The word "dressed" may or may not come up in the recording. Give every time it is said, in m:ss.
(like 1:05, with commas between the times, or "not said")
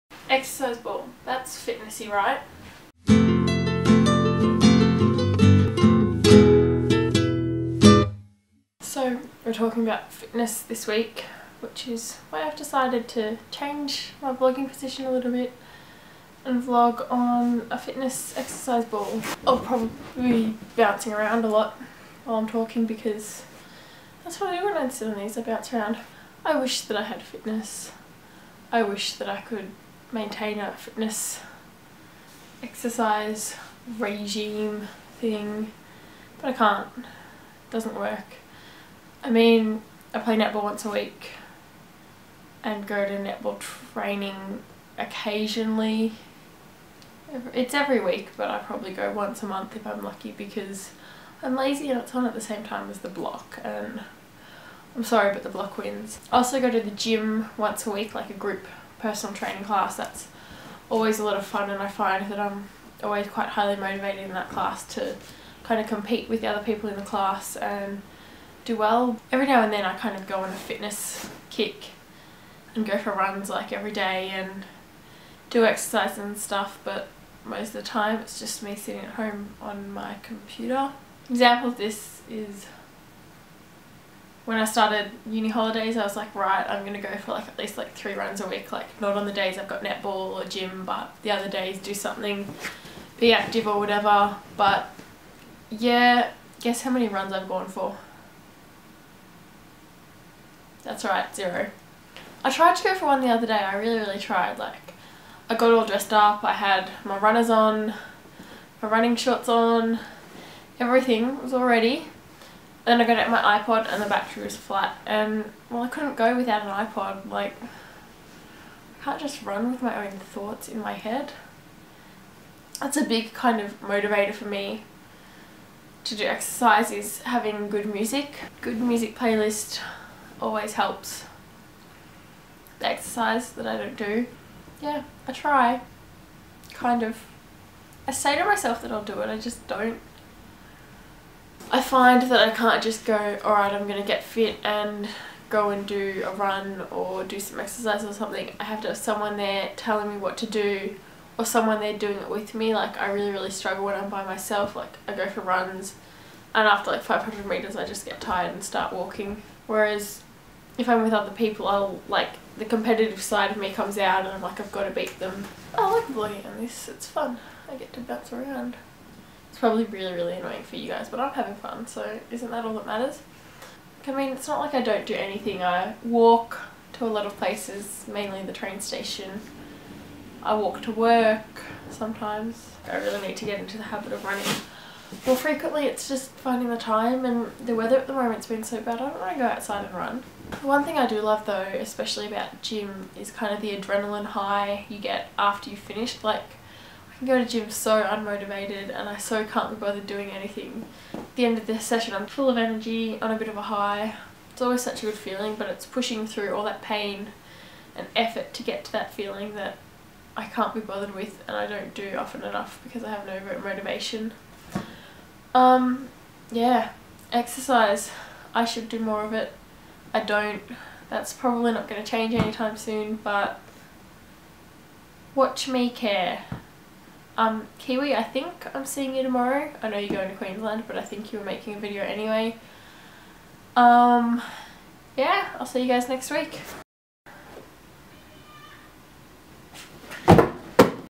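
1:45.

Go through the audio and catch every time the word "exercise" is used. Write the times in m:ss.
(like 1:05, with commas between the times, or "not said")
0:00, 0:18, 0:32, 1:15, 2:06, 2:12, 2:27, 3:37.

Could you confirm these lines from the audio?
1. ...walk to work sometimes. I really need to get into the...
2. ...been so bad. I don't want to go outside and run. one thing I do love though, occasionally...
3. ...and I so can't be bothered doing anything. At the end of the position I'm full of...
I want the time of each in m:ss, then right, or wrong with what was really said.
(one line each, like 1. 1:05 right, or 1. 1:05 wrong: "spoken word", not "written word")
1. 3:00 right
2. 3:08 wrong: "especially", not "occasionally"
3. 3:18 wrong: "session", not "position".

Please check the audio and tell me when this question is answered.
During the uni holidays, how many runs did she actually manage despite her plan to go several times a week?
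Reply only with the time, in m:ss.
1:41.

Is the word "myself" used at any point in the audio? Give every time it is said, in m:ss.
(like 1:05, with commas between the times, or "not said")
2:18, 2:34.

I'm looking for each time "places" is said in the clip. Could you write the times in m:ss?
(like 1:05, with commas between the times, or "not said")
2:57.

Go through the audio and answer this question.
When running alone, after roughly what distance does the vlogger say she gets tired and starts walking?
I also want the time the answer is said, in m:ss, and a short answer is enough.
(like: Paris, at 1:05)
500 meters, at 2:37.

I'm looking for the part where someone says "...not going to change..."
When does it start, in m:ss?
3:41.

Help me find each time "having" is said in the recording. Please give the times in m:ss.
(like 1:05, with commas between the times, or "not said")
2:07, 2:51.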